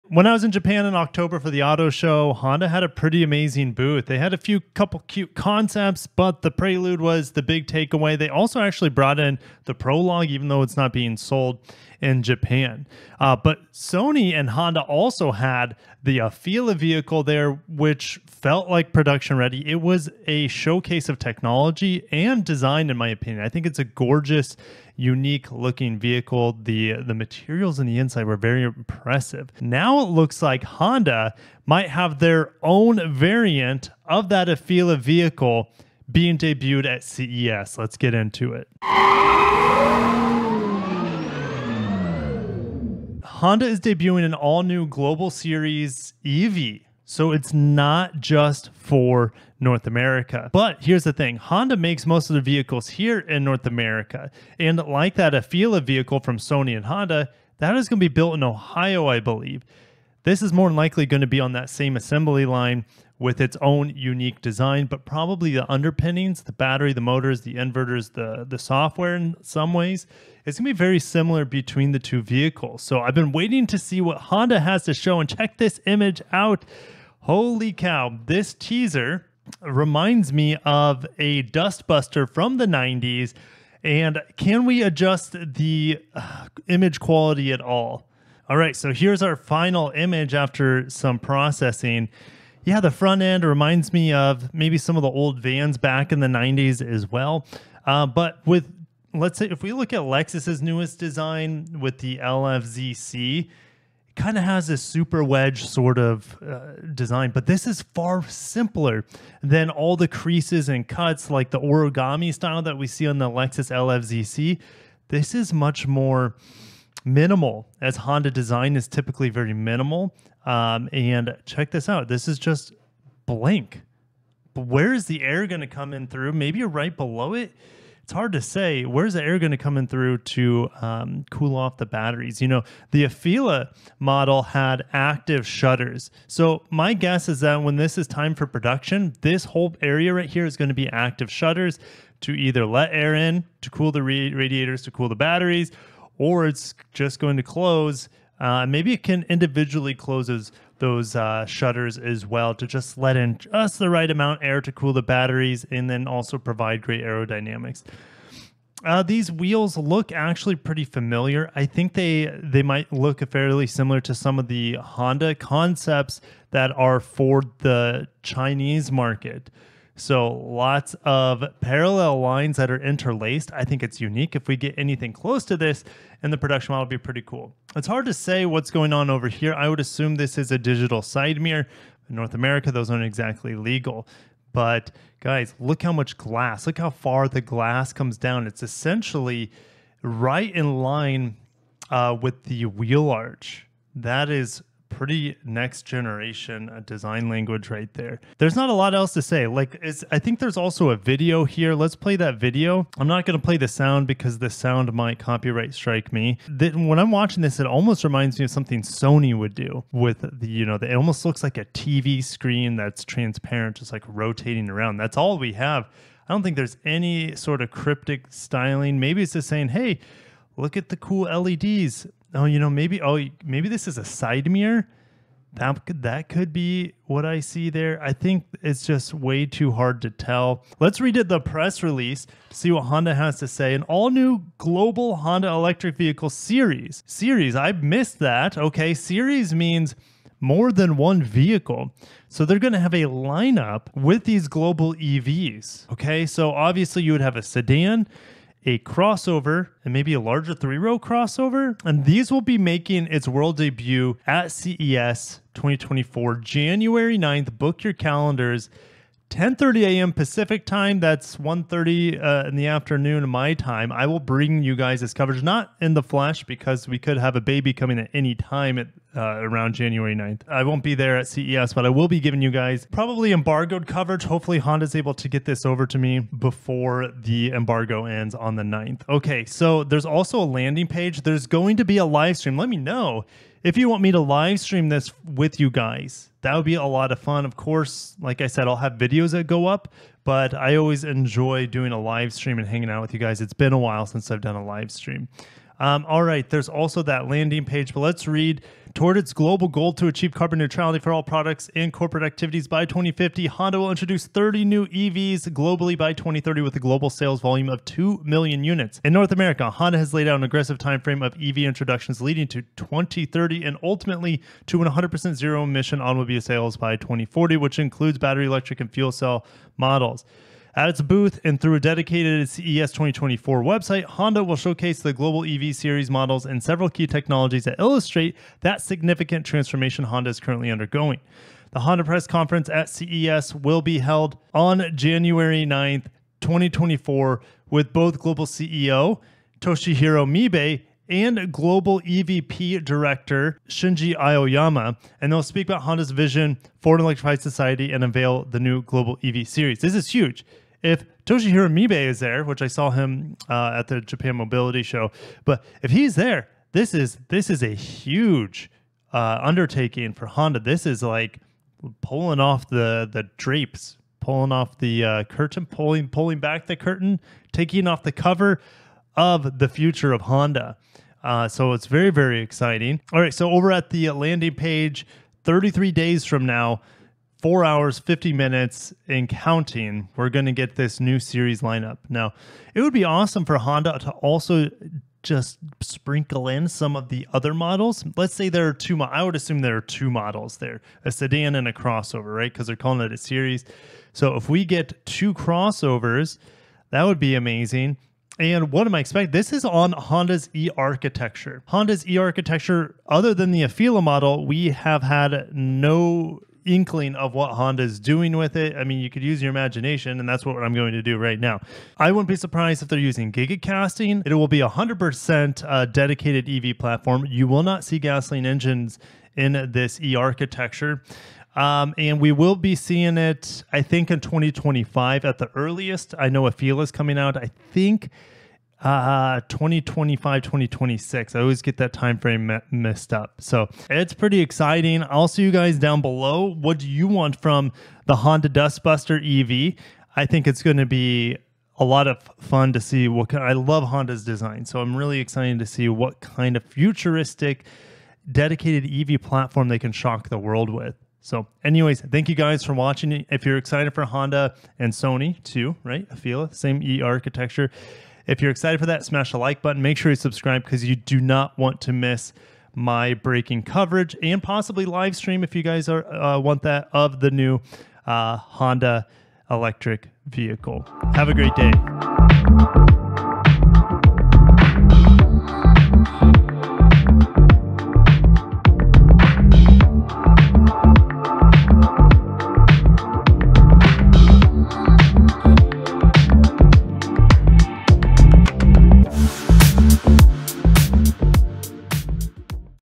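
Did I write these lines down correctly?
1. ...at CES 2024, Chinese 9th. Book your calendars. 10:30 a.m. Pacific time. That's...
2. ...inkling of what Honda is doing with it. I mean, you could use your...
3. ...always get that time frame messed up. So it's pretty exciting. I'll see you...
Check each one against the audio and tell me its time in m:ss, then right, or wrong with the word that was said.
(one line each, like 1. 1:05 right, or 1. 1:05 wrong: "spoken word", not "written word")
1. 4:14 wrong: "January", not "Chinese"
2. 6:46 right
3. 7:11 right.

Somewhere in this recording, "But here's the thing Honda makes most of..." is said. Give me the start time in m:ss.
0:50.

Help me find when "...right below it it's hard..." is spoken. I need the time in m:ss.
2:06.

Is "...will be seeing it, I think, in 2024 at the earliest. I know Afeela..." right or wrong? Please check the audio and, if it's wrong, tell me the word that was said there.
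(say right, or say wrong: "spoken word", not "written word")
wrong: "2025", not "2024".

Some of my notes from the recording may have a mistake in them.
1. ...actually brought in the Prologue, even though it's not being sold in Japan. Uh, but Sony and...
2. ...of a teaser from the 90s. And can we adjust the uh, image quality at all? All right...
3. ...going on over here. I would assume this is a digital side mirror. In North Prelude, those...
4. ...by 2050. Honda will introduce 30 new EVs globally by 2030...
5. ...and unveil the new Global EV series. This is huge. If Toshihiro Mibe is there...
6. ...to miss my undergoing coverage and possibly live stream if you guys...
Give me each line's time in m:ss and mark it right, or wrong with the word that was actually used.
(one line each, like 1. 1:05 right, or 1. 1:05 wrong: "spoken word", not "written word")
1. 0:08 right
2. 1:20 wrong: "dustbuster", not "teaser"
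3. 2:58 wrong: "America", not "Prelude"
4. 5:02 right
5. 5:47 right
6. 7:41 wrong: "breaking", not "undergoing".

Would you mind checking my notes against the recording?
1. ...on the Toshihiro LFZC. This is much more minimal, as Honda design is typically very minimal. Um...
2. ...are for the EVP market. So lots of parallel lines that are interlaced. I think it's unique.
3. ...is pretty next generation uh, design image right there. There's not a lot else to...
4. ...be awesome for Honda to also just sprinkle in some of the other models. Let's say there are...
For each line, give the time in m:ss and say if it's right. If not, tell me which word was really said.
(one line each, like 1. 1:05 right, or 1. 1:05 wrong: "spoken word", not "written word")
1. 1:53 wrong: "Lexus", not "Toshihiro"
2. 2:46 wrong: "Chinese", not "EVP"
3. 3:14 wrong: "language", not "image"
4. 6:22 right.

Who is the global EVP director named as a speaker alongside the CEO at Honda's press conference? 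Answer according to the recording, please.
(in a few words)
Shinji Aoyama.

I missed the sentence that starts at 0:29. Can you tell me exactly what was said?
Now it looks like Honda might have their own variant of that Afeela vehicle being debuted at CES.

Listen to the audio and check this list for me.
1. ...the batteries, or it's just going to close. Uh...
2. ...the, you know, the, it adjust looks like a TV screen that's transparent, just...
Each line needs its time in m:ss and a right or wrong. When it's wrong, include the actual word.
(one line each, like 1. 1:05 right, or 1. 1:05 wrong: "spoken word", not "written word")
1. 2:25 right
2. 3:30 wrong: "almost", not "adjust".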